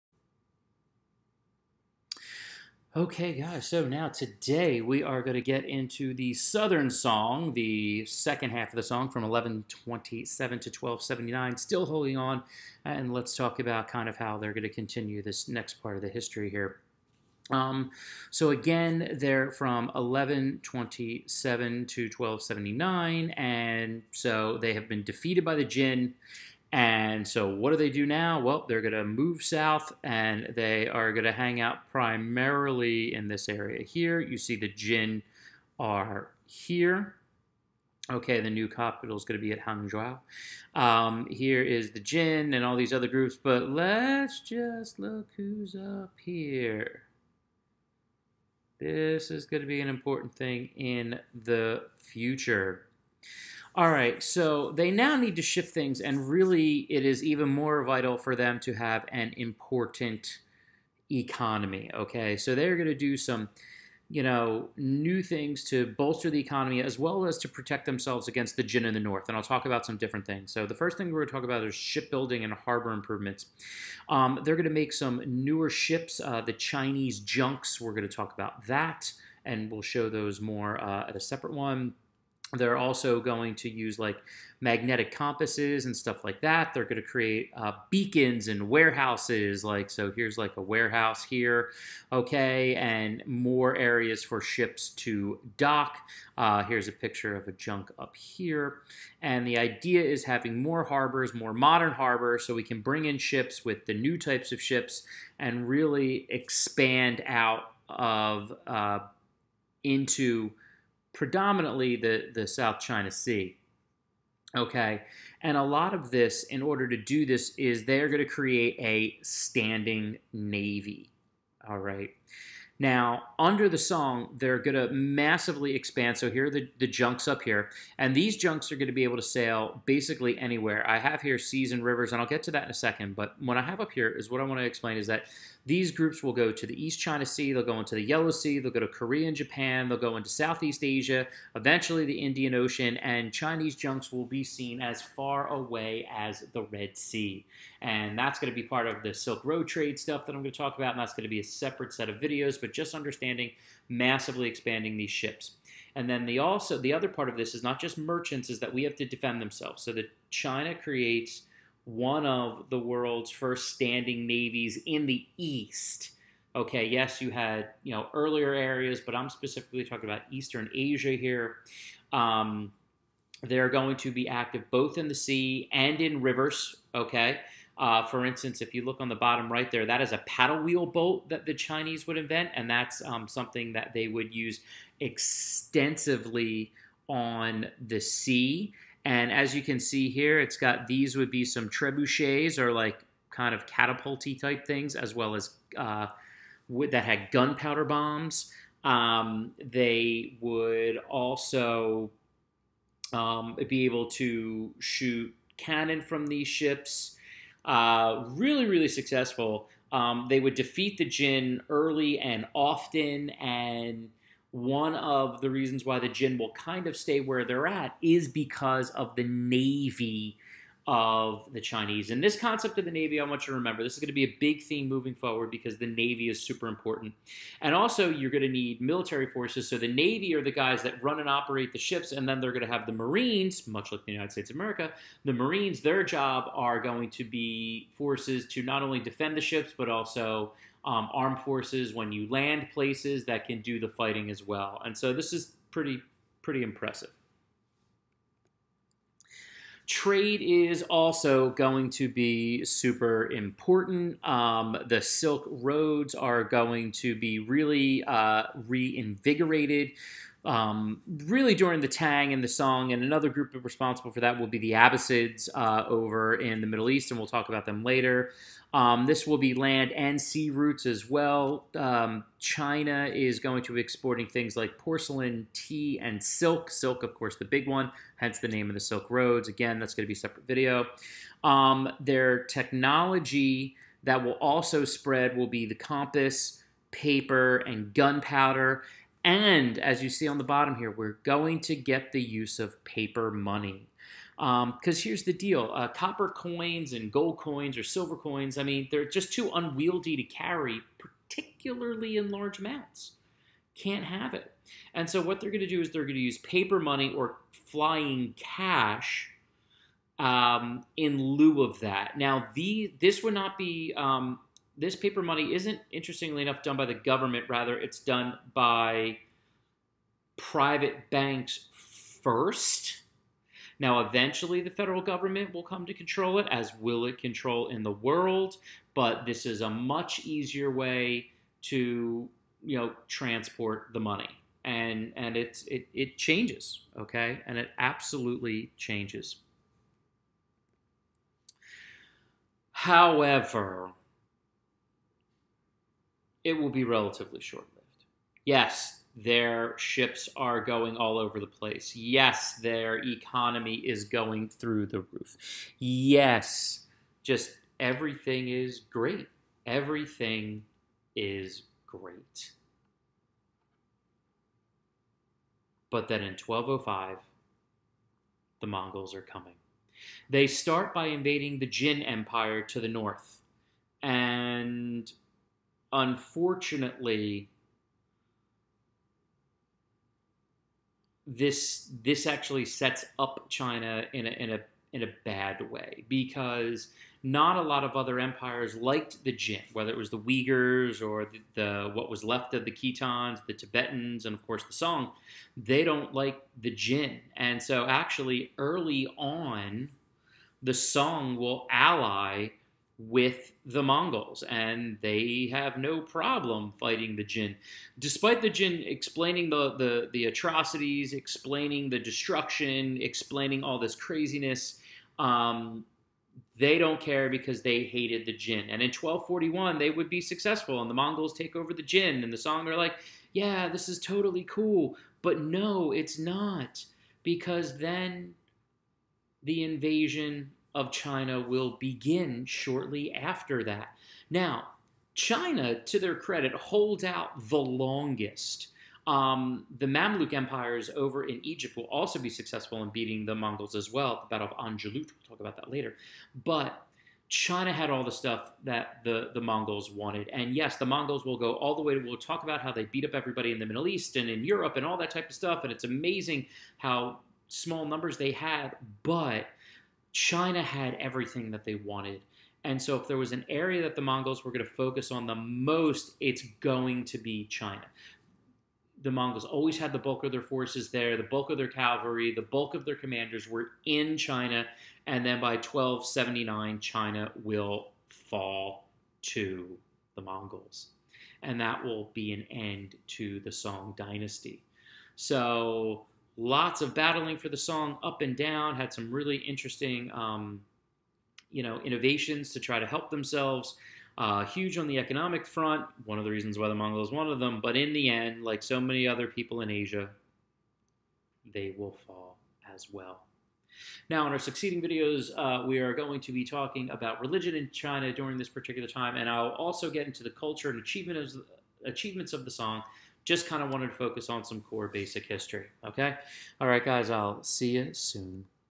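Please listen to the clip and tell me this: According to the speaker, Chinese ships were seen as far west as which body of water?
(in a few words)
Red Sea.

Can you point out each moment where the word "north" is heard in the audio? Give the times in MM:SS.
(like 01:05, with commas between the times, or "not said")
01:08, 06:12.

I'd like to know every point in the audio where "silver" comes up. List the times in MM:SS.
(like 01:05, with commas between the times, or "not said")
04:57.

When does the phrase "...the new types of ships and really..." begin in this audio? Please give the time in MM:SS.
01:43.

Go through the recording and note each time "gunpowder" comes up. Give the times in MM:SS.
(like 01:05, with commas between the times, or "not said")
03:17, 04:47.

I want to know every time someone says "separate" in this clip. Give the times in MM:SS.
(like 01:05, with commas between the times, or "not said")
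01:21, 02:31, 04:40.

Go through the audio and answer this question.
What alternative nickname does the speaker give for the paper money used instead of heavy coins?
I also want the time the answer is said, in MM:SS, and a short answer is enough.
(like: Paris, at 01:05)
flying cash, at 05:07.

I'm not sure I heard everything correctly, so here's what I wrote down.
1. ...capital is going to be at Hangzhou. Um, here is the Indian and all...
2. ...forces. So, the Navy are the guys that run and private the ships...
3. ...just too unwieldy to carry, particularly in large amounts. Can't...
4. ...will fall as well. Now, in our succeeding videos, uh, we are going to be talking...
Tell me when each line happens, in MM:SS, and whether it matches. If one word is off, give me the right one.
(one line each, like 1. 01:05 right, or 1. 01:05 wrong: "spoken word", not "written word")
1. 00:38 wrong: "Jin", not "Indian"
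2. 03:49 wrong: "operate", not "private"
3. 04:59 right
4. 08:21 right.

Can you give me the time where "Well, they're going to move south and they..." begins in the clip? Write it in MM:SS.
00:28.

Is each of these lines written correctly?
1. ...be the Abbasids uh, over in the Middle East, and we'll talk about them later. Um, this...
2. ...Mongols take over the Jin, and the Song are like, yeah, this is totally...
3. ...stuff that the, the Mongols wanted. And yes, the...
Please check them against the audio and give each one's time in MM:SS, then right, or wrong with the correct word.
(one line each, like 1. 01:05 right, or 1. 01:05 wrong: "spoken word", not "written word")
1. 04:24 right
2. 07:00 right
3. 07:28 right.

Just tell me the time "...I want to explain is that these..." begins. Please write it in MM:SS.
02:14.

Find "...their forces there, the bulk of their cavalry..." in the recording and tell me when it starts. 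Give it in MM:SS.
07:50.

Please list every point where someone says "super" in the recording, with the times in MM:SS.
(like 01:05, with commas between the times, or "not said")
03:46, 04:12.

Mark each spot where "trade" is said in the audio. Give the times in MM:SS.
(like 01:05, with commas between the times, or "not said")
02:29, 04:09.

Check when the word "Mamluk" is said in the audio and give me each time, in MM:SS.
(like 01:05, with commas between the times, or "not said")
07:19.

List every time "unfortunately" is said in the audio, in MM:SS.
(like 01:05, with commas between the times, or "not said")
06:15.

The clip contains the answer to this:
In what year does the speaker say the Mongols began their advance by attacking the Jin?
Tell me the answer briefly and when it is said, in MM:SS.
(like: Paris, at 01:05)
1205, at 06:06.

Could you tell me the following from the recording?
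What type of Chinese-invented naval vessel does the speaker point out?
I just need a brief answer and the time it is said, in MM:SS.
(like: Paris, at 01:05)
paddle wheel boat, at 03:00.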